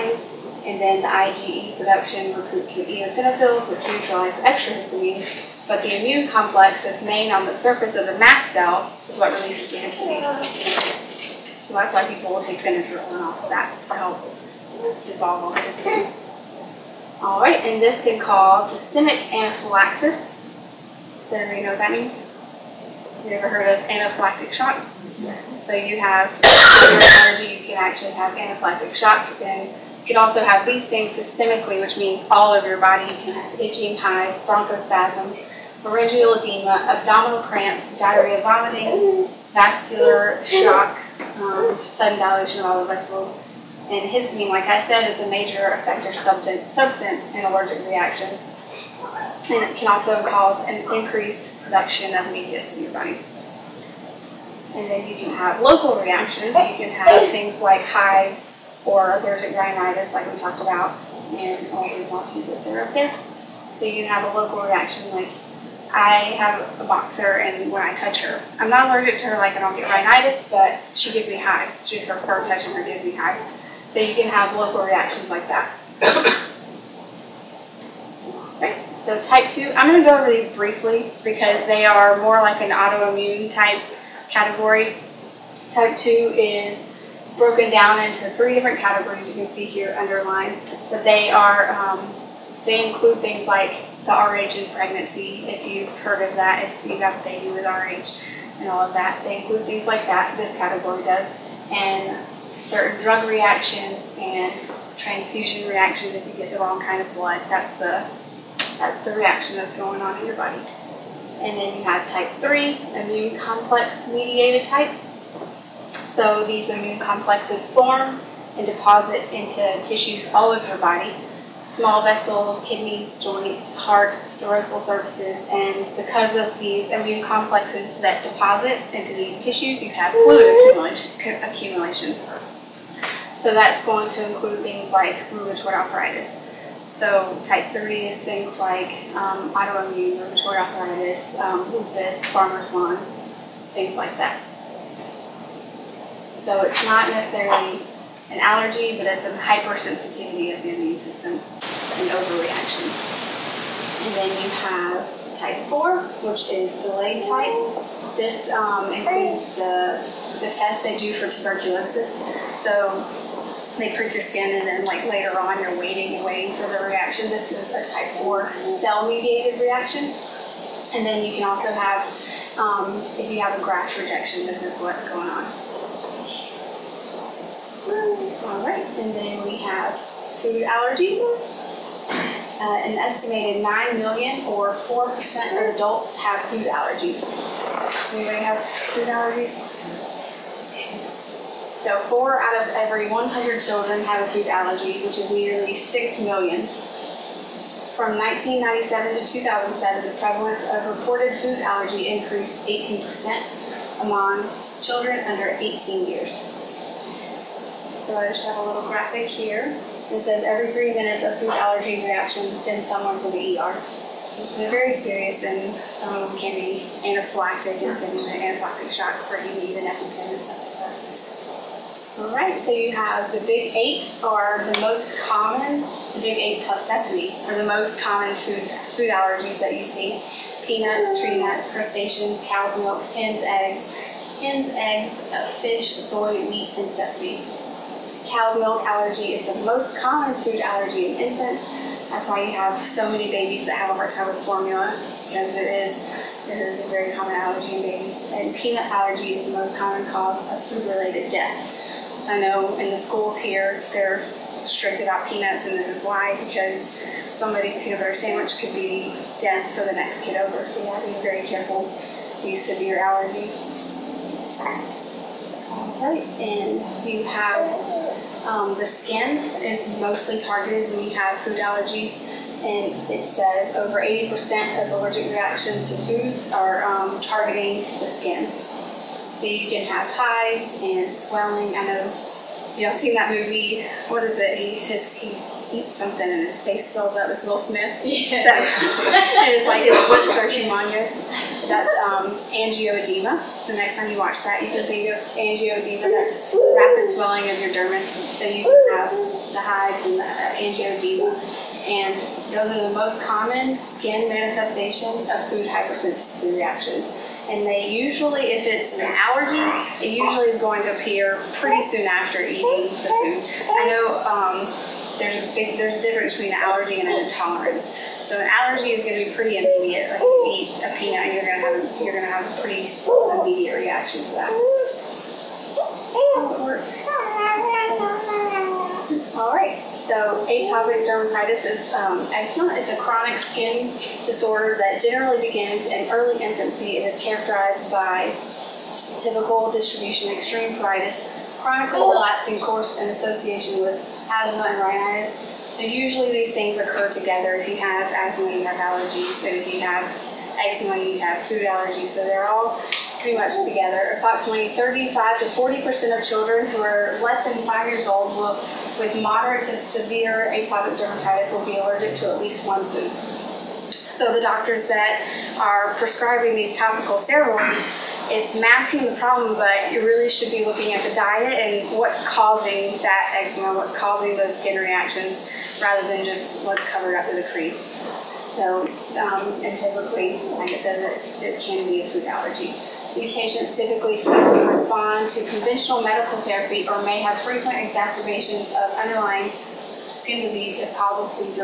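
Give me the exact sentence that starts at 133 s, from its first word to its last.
So that's going to include things like rheumatoid arthritis.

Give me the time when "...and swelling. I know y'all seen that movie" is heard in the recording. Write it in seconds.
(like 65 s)
280 s.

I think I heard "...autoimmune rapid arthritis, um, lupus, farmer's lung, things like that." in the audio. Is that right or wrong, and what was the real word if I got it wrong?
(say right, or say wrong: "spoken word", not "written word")
wrong: "rheumatoid", not "rapid".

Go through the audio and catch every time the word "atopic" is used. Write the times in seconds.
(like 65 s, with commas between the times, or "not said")
330 s, 360 s.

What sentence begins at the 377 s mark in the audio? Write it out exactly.
So, um, and typically, like I said, it, it can be a food allergy.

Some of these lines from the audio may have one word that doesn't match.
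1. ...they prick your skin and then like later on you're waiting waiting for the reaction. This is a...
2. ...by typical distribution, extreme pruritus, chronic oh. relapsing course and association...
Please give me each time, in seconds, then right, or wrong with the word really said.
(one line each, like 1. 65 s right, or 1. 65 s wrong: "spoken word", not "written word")
1. 163 s right
2. 337 s right.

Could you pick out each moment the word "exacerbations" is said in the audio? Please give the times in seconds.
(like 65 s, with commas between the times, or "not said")
387 s.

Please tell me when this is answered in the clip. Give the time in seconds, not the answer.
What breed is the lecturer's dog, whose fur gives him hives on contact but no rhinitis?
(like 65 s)
66 s.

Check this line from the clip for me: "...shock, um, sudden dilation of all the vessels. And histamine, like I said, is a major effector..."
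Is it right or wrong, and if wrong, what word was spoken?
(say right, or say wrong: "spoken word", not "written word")
right.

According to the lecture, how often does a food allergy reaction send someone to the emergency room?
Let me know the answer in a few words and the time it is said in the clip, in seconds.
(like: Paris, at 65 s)
every three minutes, at 210 s.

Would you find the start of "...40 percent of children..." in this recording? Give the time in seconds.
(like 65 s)
355 s.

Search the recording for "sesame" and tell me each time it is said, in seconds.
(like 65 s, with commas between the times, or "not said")
226 s, 236 s.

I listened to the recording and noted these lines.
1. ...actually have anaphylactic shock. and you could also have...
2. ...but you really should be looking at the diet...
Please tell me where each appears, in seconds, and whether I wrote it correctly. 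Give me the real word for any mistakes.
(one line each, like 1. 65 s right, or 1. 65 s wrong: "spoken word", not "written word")
1. 27 s right
2. 369 s right.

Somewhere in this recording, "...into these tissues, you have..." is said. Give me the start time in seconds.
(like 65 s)
128 s.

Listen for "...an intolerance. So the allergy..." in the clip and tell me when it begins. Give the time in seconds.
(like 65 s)
317 s.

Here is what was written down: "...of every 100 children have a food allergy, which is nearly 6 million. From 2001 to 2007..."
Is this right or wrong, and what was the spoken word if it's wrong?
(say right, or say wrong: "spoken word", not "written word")
wrong: "1997", not "2001".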